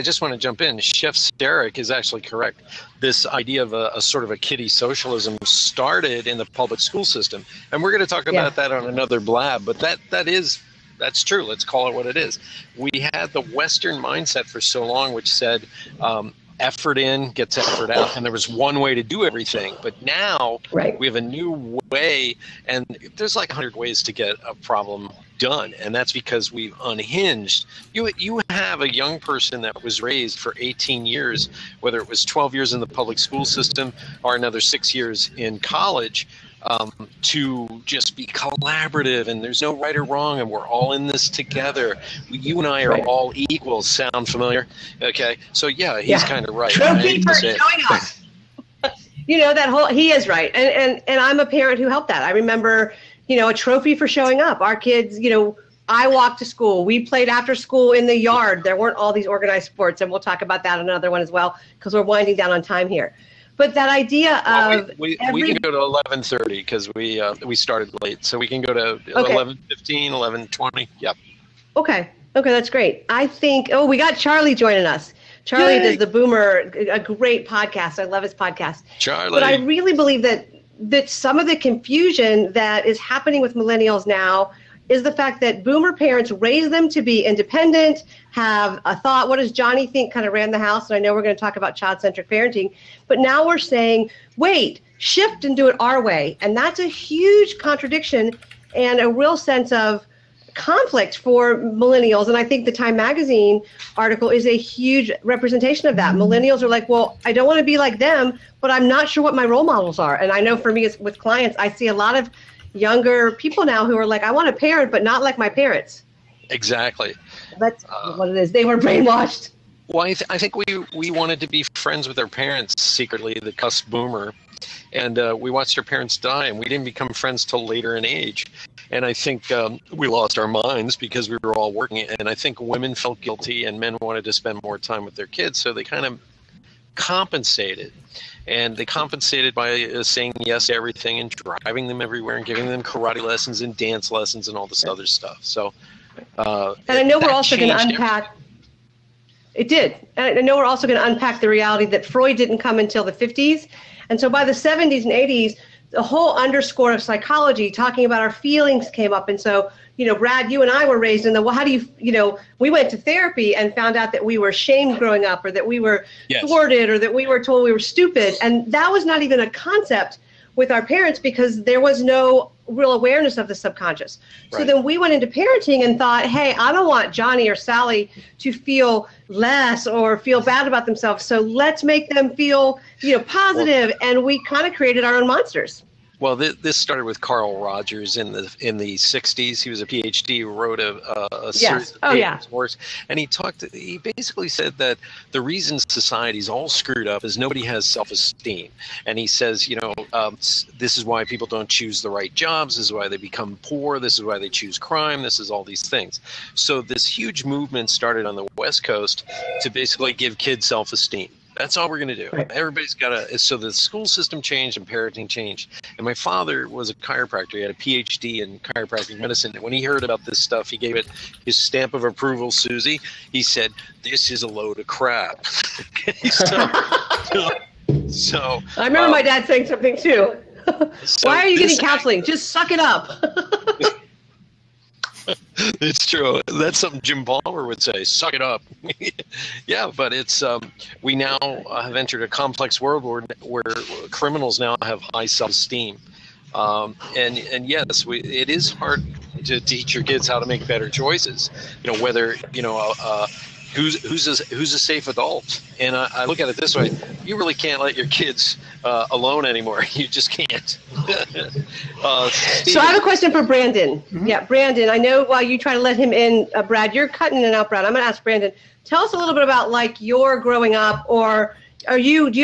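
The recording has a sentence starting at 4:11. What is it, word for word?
You know, whether you know a, uh, uh, who's who's a, who's a safe adult?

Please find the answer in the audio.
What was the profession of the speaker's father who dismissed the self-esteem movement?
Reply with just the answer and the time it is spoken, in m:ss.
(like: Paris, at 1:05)
chiropractor, at 3:36.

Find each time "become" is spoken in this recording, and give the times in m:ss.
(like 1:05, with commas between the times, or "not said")
2:06, 3:23.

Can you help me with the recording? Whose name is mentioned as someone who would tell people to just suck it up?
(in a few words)
Jim Palmer.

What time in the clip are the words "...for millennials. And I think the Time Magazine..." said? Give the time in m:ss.
1:41.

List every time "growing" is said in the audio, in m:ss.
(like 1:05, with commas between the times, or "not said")
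2:44, 4:30.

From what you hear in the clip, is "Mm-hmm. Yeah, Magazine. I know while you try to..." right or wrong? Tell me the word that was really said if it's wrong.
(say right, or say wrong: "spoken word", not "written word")
wrong: "Brandon", not "Magazine".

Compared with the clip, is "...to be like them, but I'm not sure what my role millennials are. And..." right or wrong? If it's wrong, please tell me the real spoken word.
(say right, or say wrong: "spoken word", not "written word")
wrong: "models", not "millennials".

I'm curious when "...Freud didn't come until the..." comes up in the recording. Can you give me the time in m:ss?
2:32.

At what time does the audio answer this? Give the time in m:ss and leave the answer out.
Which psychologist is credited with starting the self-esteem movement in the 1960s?
3:07.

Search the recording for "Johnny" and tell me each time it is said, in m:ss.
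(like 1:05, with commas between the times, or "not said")
1:29, 2:57.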